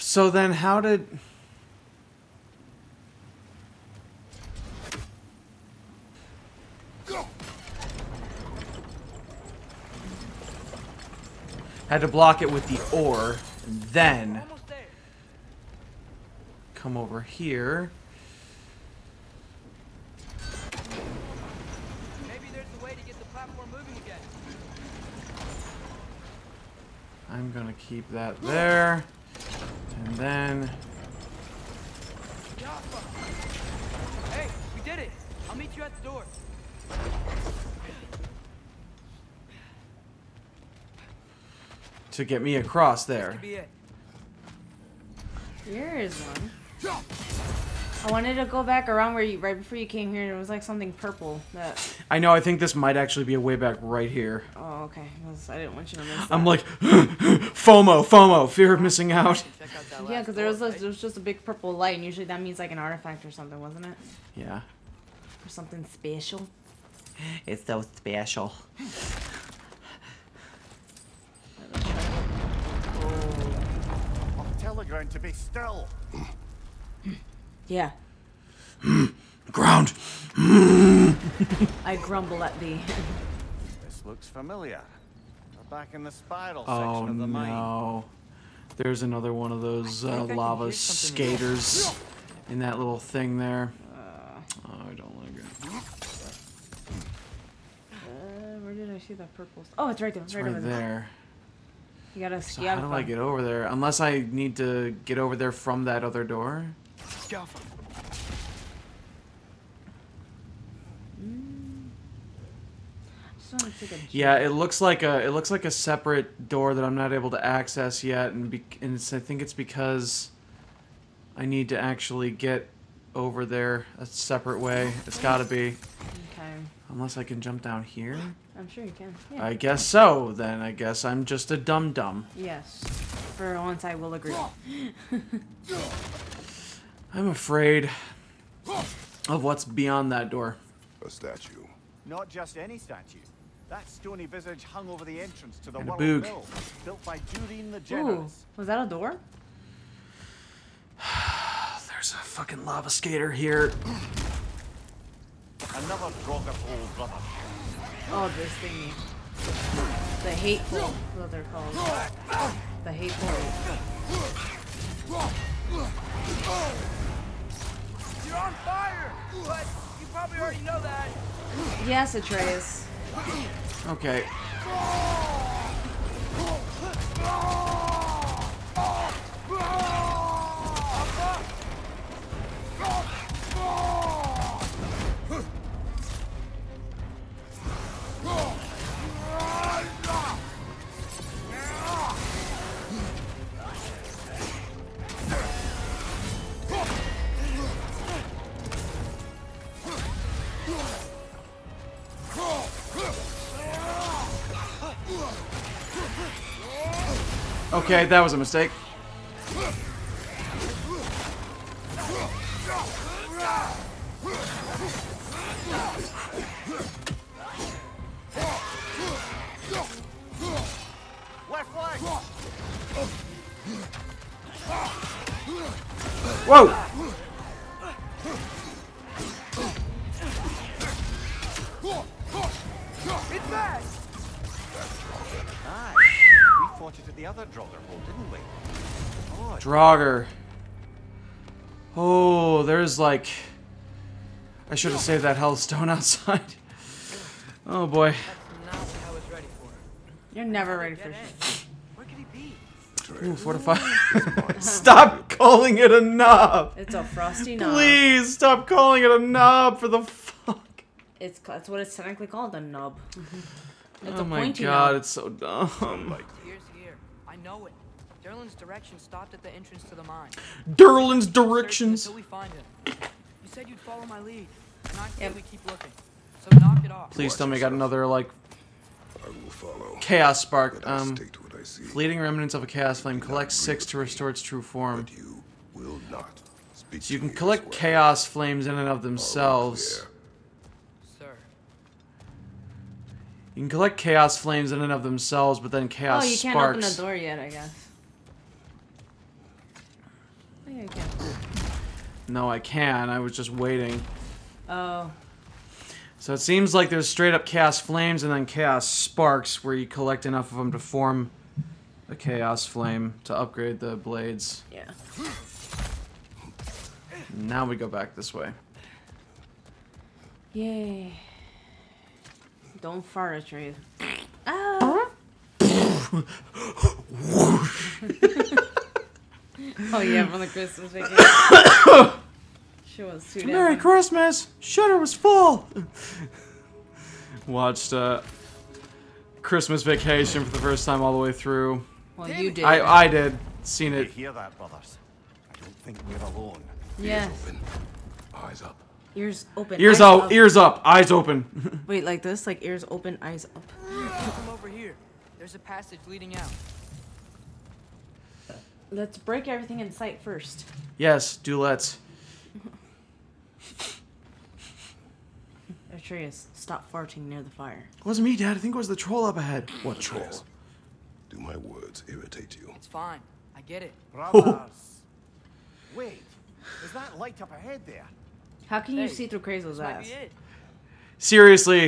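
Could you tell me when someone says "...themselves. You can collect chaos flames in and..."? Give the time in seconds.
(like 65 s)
289 s.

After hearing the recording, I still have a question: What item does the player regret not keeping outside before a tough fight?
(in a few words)
hellstone.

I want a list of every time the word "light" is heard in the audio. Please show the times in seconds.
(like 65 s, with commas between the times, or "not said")
61 s, 377 s.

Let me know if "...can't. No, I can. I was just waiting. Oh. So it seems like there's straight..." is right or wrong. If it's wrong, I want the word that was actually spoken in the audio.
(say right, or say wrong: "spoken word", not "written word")
right.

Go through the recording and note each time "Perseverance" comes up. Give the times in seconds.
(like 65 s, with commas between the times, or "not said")
not said.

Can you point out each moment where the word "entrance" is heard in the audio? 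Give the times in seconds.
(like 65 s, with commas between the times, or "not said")
145 s, 269 s.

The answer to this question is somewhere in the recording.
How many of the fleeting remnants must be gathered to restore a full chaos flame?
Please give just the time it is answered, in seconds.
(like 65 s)
283 s.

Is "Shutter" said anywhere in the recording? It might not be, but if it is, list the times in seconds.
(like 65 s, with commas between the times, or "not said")
334 s.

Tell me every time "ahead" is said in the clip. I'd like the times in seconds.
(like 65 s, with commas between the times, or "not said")
369 s, 377 s.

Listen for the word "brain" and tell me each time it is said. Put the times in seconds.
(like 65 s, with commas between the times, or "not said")
not said.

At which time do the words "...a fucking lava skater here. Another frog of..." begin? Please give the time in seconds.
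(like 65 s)
152 s.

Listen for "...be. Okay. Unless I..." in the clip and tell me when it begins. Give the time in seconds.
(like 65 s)
125 s.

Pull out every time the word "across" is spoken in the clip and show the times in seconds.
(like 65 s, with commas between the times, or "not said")
42 s.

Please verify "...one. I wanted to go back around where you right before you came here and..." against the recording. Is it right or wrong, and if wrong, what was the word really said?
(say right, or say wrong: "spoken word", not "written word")
right.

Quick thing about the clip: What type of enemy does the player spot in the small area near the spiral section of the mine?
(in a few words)
lava skater.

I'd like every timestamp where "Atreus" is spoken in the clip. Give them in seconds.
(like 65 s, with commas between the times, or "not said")
172 s, 365 s.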